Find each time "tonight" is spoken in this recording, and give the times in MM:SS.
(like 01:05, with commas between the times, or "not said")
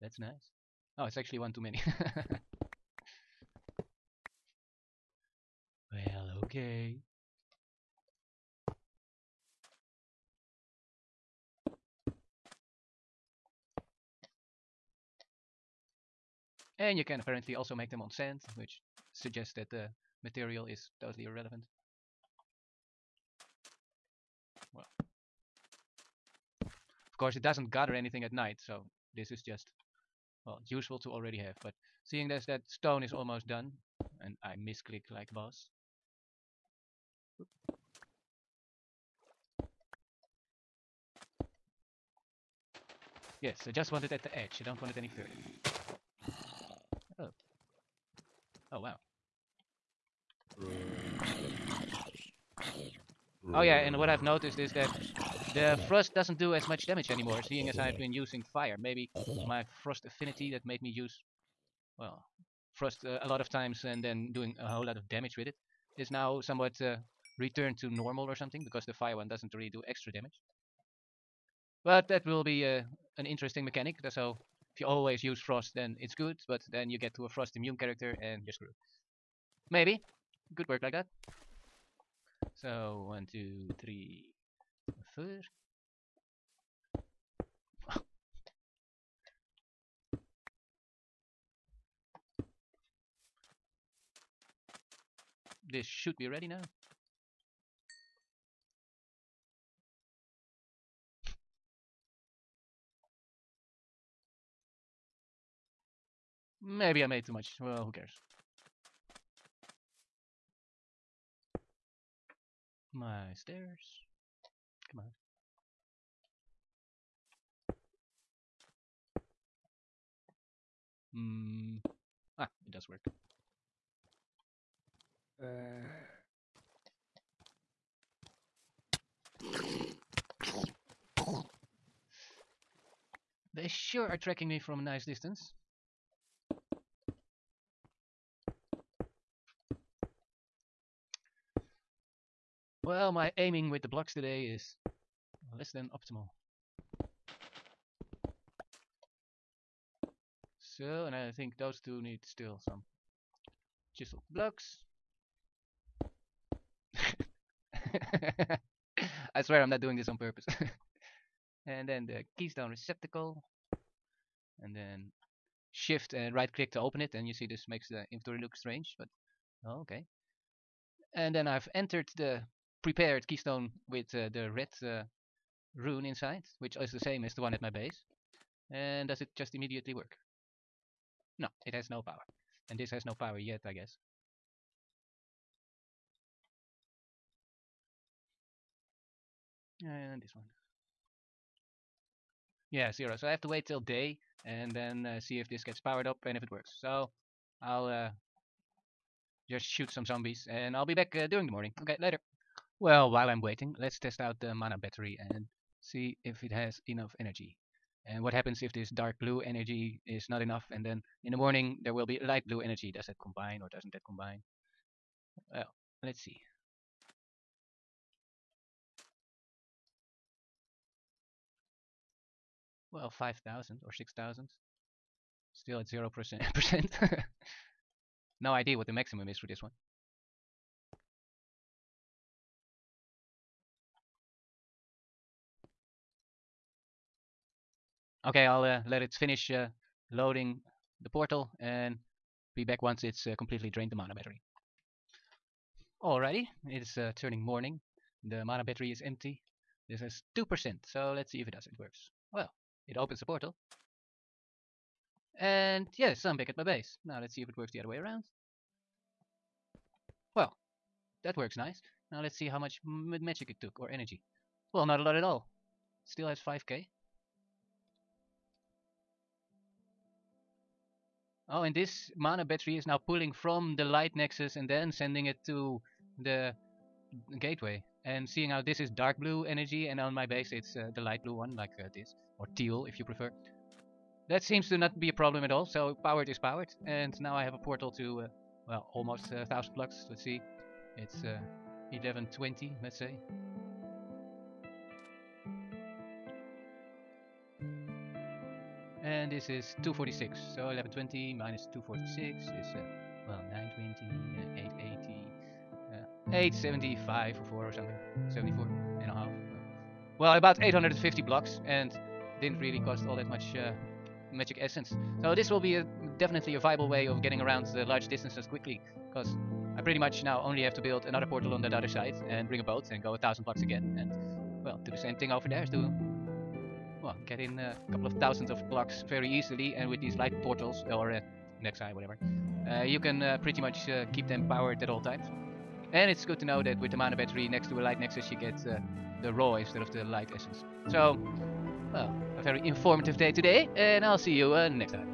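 not said.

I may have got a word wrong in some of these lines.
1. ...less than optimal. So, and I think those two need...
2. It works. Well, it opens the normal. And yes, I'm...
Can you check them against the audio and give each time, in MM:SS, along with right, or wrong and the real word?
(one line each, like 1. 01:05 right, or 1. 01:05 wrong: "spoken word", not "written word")
1. 02:25 right
2. 04:11 wrong: "portal", not "normal".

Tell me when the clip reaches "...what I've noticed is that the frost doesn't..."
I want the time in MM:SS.
00:53.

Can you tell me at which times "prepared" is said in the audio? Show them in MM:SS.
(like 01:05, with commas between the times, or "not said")
02:52.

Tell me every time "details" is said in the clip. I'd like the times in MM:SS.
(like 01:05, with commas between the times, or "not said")
not said.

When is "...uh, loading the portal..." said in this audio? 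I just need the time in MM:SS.
03:59.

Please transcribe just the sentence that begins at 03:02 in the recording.
And this has no power yet, I guess.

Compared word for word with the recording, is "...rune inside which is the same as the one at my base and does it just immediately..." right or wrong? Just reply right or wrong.
right.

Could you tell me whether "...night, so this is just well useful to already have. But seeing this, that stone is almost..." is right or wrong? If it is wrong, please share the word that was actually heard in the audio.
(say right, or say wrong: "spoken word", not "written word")
right.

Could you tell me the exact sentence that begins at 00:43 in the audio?
Yes, I just want it at the edge, I don't want it any further.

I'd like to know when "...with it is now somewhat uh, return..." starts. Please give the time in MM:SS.
01:05.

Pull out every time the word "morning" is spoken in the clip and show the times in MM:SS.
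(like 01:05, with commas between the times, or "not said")
03:21, 03:31, 04:07.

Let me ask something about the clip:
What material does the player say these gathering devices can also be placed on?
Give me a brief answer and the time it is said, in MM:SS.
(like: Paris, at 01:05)
Sand, at 00:18.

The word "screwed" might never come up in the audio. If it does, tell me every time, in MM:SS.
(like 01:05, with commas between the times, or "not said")
01:18.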